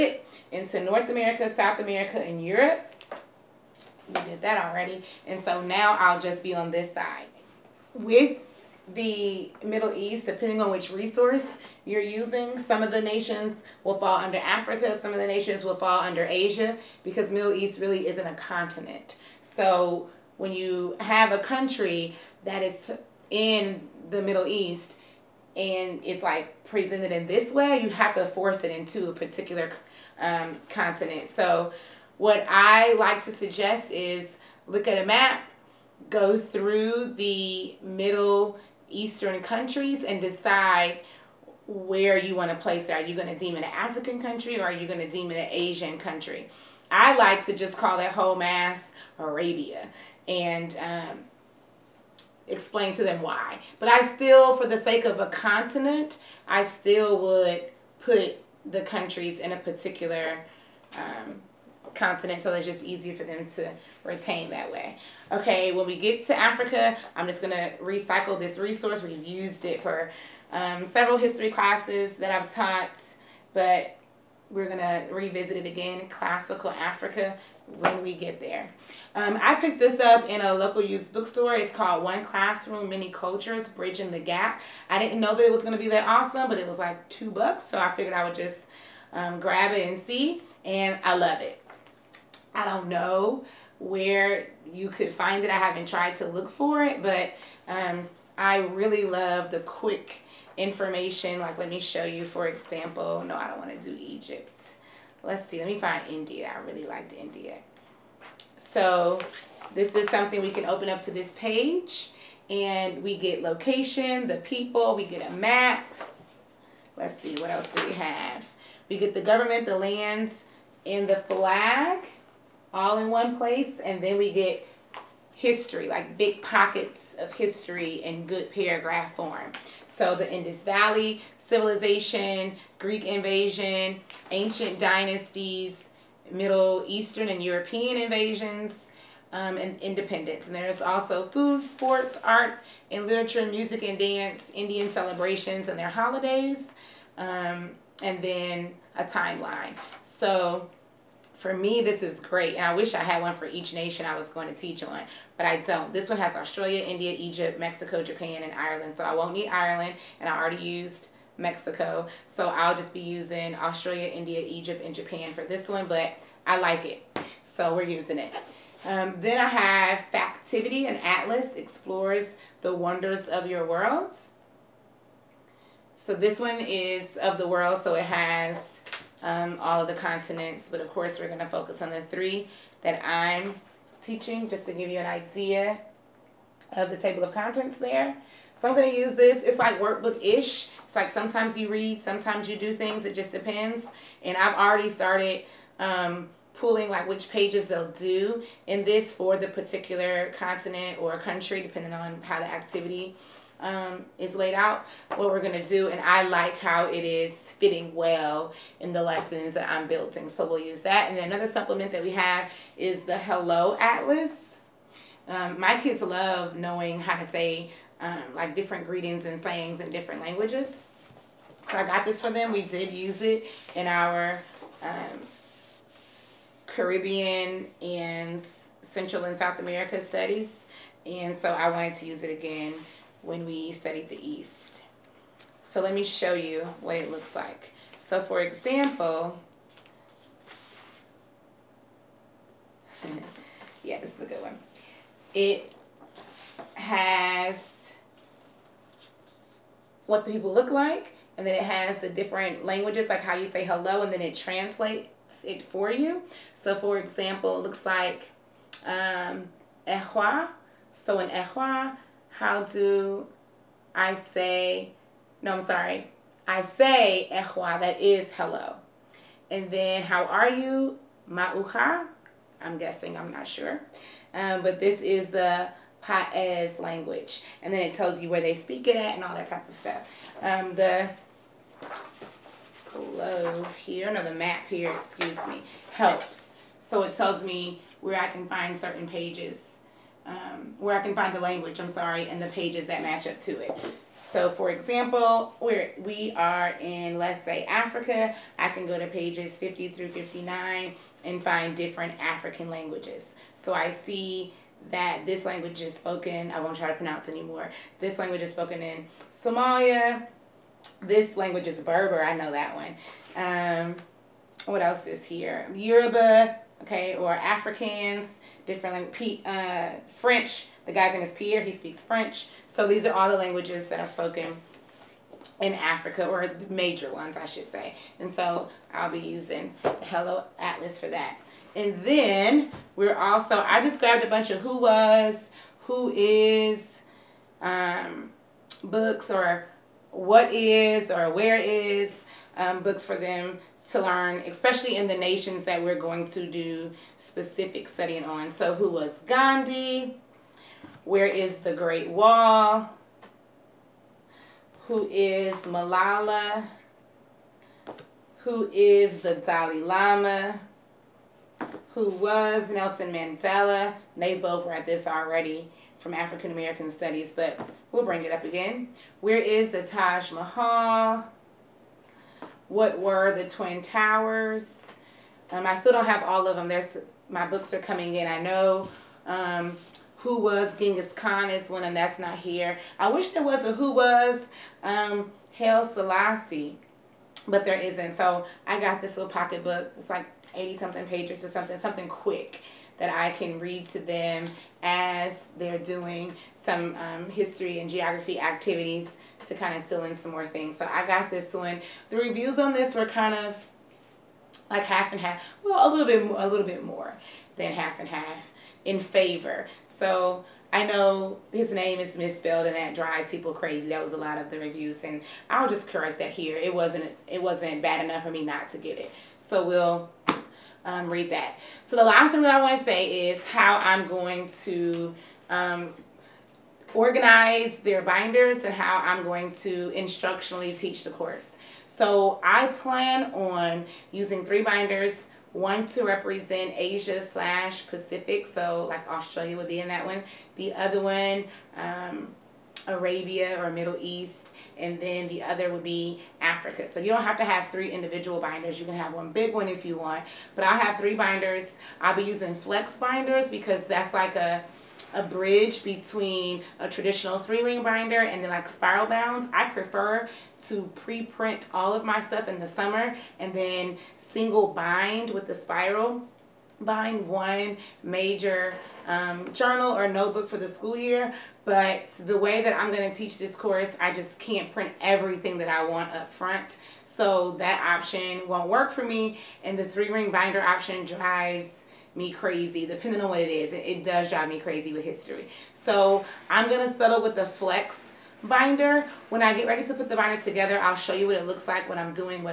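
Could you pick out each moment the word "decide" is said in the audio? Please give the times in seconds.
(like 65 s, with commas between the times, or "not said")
40 s.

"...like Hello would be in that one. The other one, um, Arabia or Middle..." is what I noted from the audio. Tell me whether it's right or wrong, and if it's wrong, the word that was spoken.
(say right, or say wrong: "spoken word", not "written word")
wrong: "Australia", not "Hello".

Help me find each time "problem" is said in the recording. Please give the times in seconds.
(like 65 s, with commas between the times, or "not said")
not said.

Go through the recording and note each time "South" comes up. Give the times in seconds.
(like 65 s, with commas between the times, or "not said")
1 s, 229 s.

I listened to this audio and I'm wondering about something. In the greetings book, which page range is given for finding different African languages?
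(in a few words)
50 through 59.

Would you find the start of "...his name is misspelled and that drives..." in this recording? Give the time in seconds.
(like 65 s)
411 s.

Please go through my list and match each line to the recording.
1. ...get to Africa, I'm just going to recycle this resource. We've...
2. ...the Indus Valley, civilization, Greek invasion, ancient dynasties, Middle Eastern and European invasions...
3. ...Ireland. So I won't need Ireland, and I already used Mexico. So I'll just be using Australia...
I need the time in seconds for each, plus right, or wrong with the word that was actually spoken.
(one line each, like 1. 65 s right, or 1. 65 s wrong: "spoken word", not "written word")
1. 65 s right
2. 130 s right
3. 158 s right.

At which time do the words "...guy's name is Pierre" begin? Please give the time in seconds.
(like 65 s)
320 s.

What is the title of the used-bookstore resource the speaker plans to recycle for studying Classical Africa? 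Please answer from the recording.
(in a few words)
One Classroom, Many Cultures.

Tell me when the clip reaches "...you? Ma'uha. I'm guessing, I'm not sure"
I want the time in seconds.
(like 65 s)
270 s.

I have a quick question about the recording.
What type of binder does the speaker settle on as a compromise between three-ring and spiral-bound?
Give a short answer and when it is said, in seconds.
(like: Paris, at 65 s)
flex binder, at 452 s.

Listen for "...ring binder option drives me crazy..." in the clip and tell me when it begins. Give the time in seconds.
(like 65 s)
480 s.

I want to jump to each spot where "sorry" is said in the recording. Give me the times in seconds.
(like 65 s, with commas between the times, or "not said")
265 s, 291 s.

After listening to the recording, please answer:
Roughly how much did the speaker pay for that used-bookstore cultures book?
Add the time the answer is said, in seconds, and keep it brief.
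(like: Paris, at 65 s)
2 dollars, at 87 s.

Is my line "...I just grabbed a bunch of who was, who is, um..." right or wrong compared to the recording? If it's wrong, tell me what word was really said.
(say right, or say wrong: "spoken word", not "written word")
right.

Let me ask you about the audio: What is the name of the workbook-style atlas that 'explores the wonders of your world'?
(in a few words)
Factivity.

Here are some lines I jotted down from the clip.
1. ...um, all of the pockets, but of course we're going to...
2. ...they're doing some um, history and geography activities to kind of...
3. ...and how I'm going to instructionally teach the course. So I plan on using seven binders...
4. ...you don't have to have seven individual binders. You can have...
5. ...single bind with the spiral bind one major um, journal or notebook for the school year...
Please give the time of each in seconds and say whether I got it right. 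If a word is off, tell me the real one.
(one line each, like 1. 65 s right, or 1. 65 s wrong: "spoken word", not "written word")
1. 179 s wrong: "continents", not "pockets"
2. 395 s right
3. 428 s wrong: "three", not "seven"
4. 446 s wrong: "three", not "seven"
5. 464 s right.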